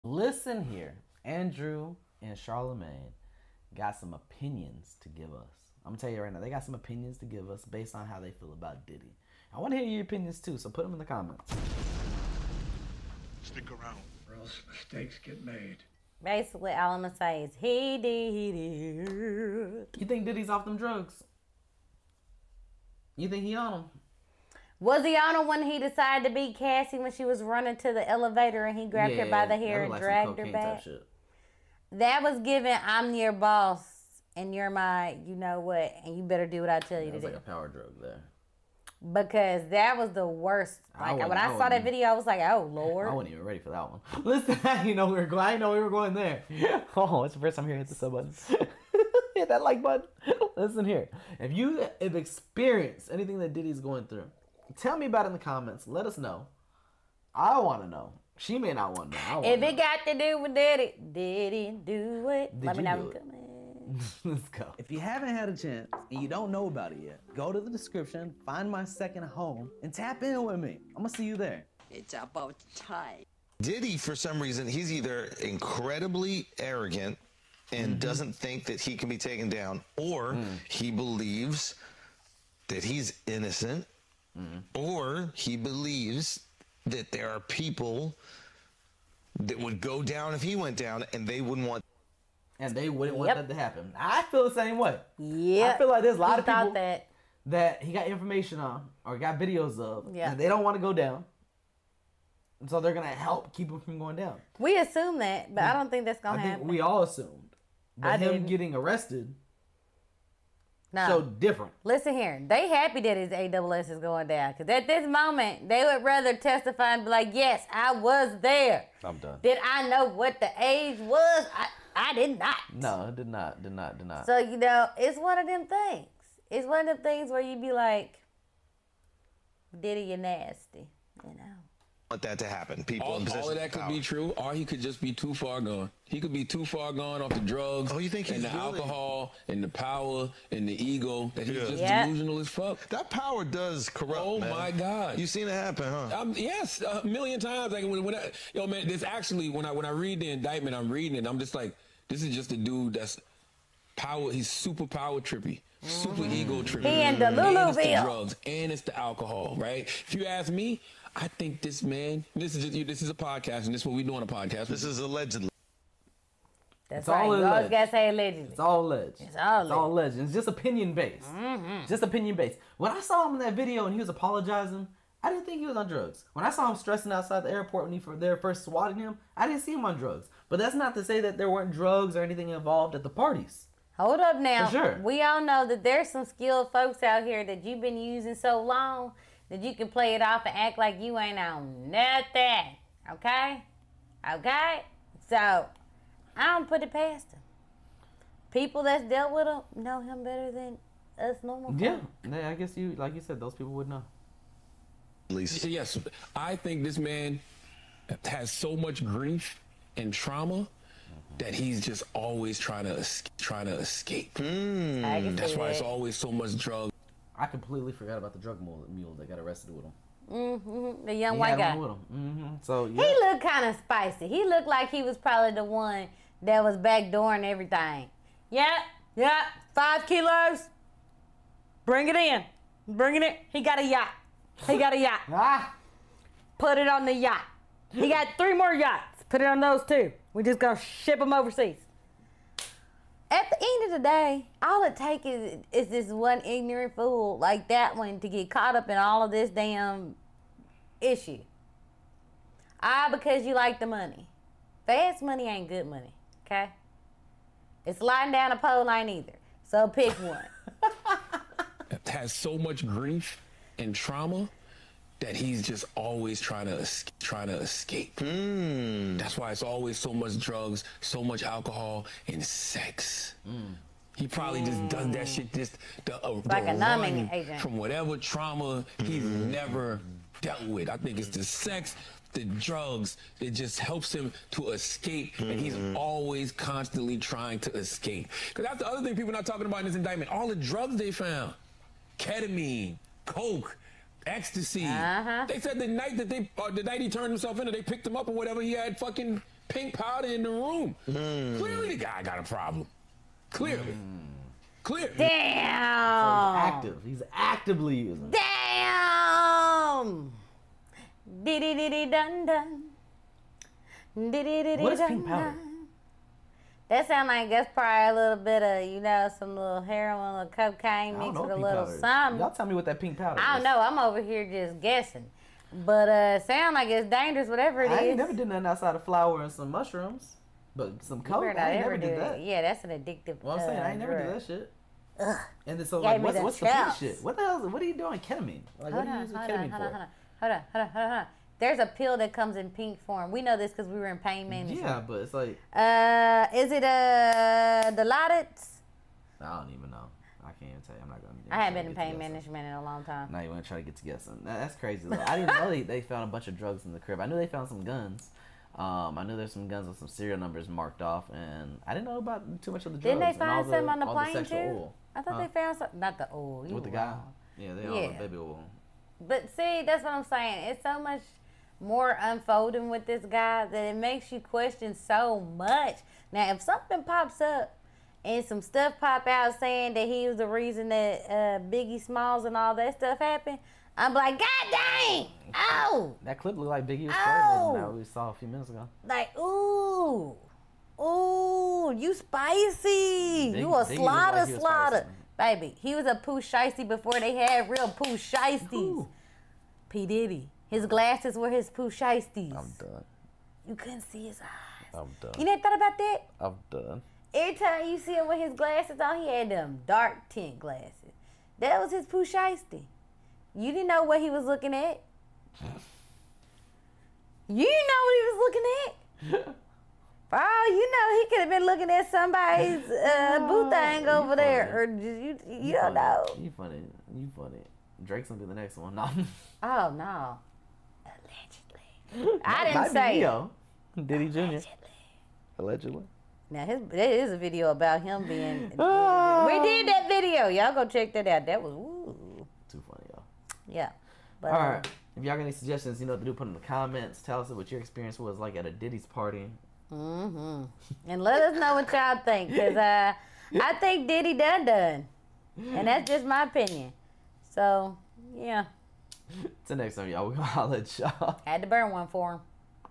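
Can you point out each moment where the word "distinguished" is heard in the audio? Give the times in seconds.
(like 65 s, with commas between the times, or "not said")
not said.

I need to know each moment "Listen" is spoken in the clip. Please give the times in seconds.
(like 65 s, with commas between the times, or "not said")
0 s, 44 s, 50 s, 111 s.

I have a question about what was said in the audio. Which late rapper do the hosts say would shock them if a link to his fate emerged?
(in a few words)
Biggie Smalls.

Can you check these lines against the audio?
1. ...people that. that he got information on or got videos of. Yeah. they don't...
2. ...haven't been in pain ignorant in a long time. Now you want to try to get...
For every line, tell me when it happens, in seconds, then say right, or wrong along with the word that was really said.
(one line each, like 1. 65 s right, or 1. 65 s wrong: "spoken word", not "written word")
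1. 96 s right
2. 351 s wrong: "management", not "ignorant".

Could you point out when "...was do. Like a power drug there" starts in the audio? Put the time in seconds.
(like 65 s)
37 s.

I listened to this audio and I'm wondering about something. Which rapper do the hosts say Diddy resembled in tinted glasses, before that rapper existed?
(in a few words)
Pooh Shiesty.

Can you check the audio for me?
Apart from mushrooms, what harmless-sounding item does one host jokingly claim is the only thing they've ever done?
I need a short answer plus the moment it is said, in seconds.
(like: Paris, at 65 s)
Flour, at 329 s.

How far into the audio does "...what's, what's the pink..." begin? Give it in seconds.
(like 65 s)
336 s.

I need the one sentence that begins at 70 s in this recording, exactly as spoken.
I'm going to see you there.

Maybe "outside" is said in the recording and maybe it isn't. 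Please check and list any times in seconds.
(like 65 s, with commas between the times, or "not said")
177 s, 328 s.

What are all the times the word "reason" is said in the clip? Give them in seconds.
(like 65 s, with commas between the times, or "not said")
74 s, 380 s.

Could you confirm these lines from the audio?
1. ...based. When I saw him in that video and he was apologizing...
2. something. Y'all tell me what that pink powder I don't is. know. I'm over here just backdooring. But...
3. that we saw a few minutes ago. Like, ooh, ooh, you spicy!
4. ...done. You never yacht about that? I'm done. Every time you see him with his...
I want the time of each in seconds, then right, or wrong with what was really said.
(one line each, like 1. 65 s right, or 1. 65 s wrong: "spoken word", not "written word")
1. 172 s right
2. 322 s wrong: "guessing", not "backdooring"
3. 387 s right
4. 405 s wrong: "thought", not "yacht".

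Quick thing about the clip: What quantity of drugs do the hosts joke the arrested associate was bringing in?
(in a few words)
5 kilos.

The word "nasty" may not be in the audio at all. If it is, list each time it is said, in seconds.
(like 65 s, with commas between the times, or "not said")
130 s.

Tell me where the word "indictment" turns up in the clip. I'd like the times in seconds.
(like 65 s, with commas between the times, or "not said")
150 s, 289 s.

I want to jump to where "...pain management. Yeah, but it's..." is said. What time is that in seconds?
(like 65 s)
344 s.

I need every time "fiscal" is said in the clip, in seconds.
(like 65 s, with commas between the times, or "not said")
not said.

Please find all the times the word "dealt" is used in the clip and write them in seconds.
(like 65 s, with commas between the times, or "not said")
199 s, 280 s.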